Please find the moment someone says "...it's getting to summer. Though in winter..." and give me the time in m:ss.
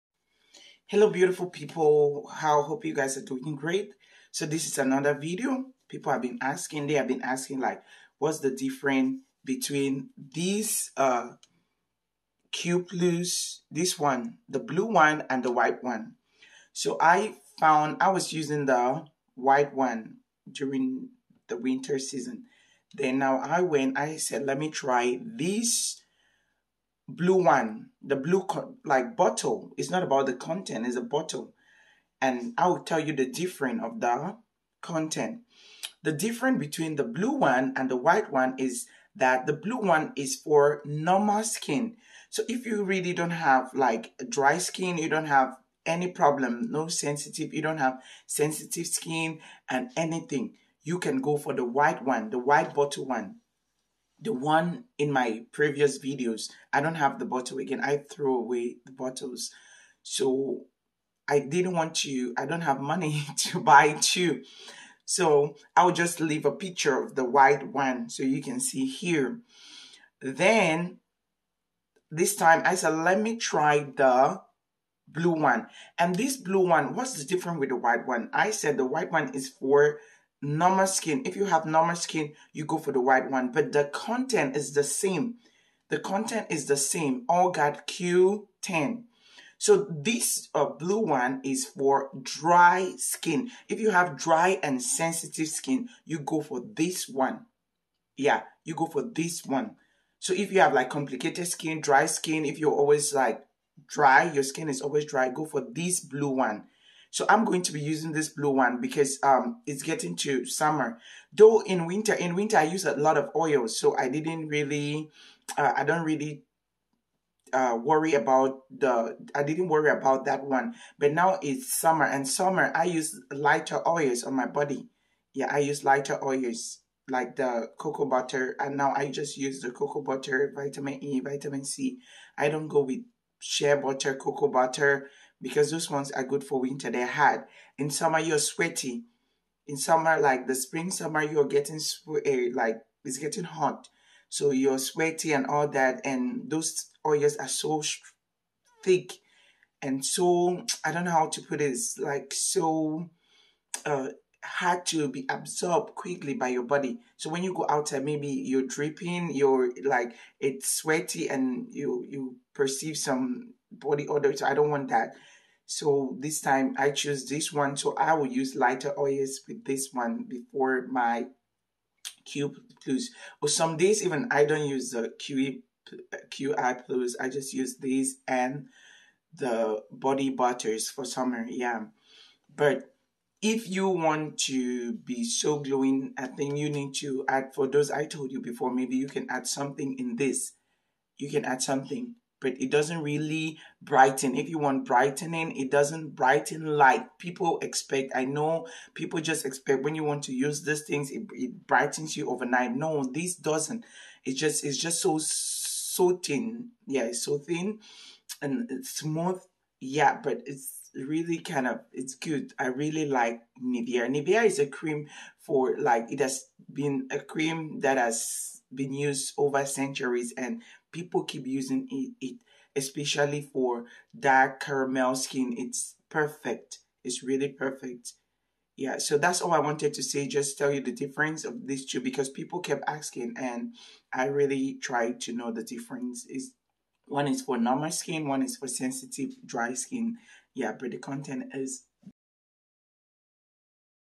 1:49.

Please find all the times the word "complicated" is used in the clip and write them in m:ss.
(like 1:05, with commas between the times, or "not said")
1:40.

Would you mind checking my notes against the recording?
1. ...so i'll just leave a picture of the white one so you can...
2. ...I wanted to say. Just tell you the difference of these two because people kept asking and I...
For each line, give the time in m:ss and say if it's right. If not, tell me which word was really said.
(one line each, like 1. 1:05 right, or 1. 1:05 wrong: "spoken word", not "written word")
1. 1:05 right
2. 3:49 right.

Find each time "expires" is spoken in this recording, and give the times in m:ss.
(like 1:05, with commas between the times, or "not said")
not said.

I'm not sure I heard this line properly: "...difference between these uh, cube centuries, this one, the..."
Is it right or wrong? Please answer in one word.
wrong.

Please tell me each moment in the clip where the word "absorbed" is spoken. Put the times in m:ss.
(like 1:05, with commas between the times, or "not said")
2:35.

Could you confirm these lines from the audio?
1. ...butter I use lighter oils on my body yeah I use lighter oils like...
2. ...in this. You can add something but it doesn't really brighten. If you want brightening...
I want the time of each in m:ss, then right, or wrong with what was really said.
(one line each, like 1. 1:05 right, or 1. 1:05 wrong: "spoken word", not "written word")
1. 2:02 wrong: "summer", not "butter"
2. 3:09 right.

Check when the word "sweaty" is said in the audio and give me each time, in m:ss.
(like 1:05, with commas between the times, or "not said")
2:18, 2:24, 2:40.